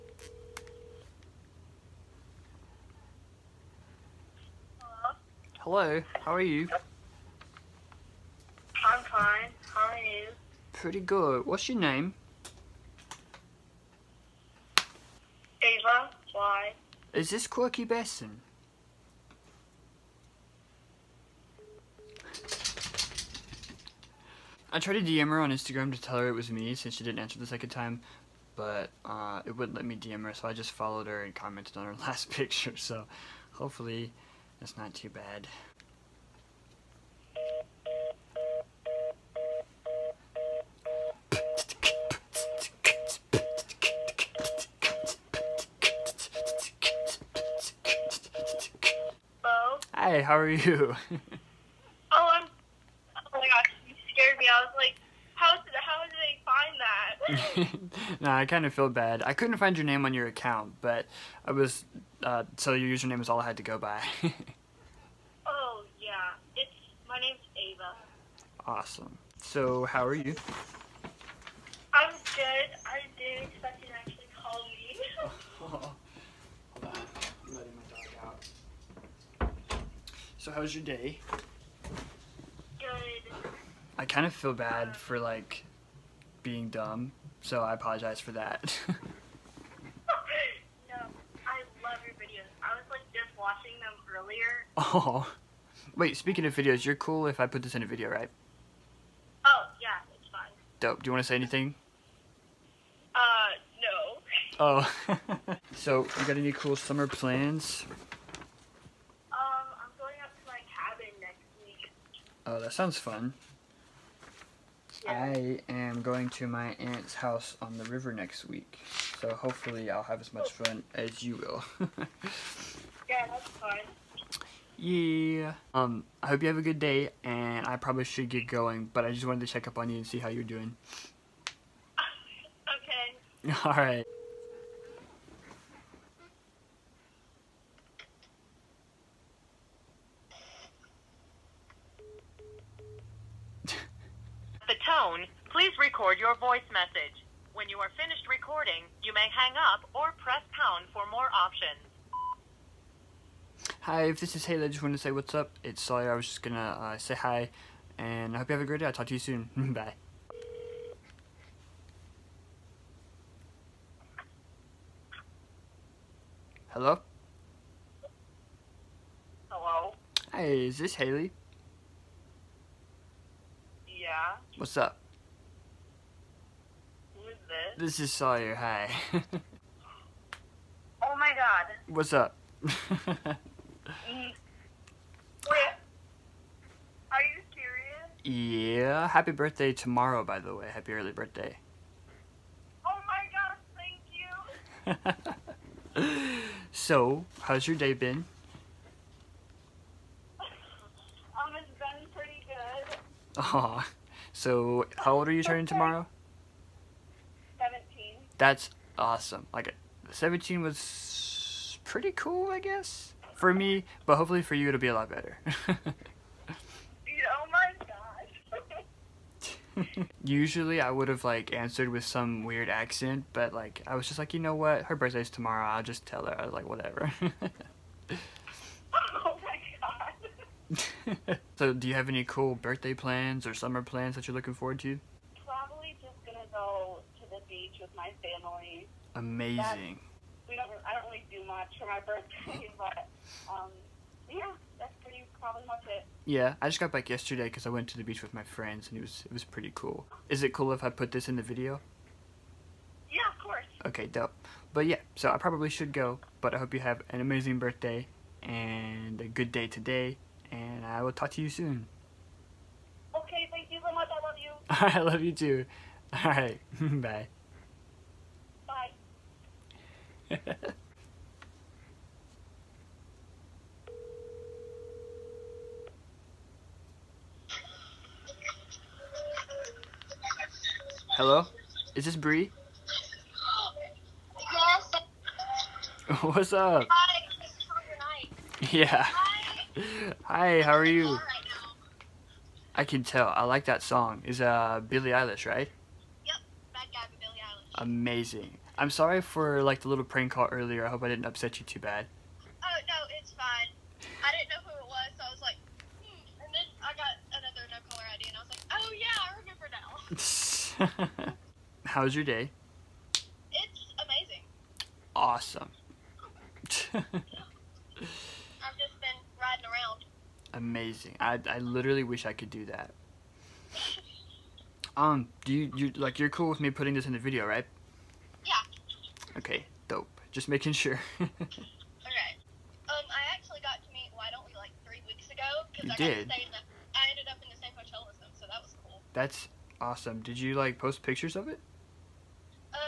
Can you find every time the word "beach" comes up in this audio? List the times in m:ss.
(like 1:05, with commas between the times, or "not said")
3:57, 4:08.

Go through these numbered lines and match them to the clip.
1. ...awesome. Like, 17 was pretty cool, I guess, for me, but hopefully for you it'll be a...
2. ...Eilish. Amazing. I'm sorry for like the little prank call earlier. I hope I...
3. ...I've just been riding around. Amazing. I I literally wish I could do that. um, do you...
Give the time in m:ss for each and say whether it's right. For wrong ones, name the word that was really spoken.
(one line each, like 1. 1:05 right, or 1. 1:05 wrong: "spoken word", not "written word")
1. 3:28 right
2. 4:57 right
3. 5:16 right.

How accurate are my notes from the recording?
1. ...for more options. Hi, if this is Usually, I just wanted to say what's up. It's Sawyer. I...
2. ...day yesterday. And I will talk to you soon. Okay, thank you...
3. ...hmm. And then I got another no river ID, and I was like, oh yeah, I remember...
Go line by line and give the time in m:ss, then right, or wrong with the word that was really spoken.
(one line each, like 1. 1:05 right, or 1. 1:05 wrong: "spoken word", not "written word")
1. 2:30 wrong: "Haley", not "Usually"
2. 4:19 wrong: "today", not "yesterday"
3. 5:06 wrong: "caller", not "river".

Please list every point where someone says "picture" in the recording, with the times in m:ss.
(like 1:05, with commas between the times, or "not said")
0:32, 5:41.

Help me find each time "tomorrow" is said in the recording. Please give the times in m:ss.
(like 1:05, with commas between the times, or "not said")
3:09, 3:25, 3:45.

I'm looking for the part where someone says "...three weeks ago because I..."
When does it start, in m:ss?
5:34.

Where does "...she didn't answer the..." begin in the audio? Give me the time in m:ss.
0:26.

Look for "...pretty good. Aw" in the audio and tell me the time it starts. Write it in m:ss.
3:22.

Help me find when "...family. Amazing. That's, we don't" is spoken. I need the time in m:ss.
3:58.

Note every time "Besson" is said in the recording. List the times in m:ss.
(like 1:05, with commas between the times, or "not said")
0:17.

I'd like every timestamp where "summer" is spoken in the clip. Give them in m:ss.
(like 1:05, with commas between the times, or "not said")
1:46, 3:53.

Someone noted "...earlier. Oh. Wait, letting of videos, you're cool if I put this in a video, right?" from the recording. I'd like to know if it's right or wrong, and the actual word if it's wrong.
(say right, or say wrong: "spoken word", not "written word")
wrong: "speaking", not "letting".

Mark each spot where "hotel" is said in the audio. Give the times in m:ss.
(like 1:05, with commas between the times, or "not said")
5:37.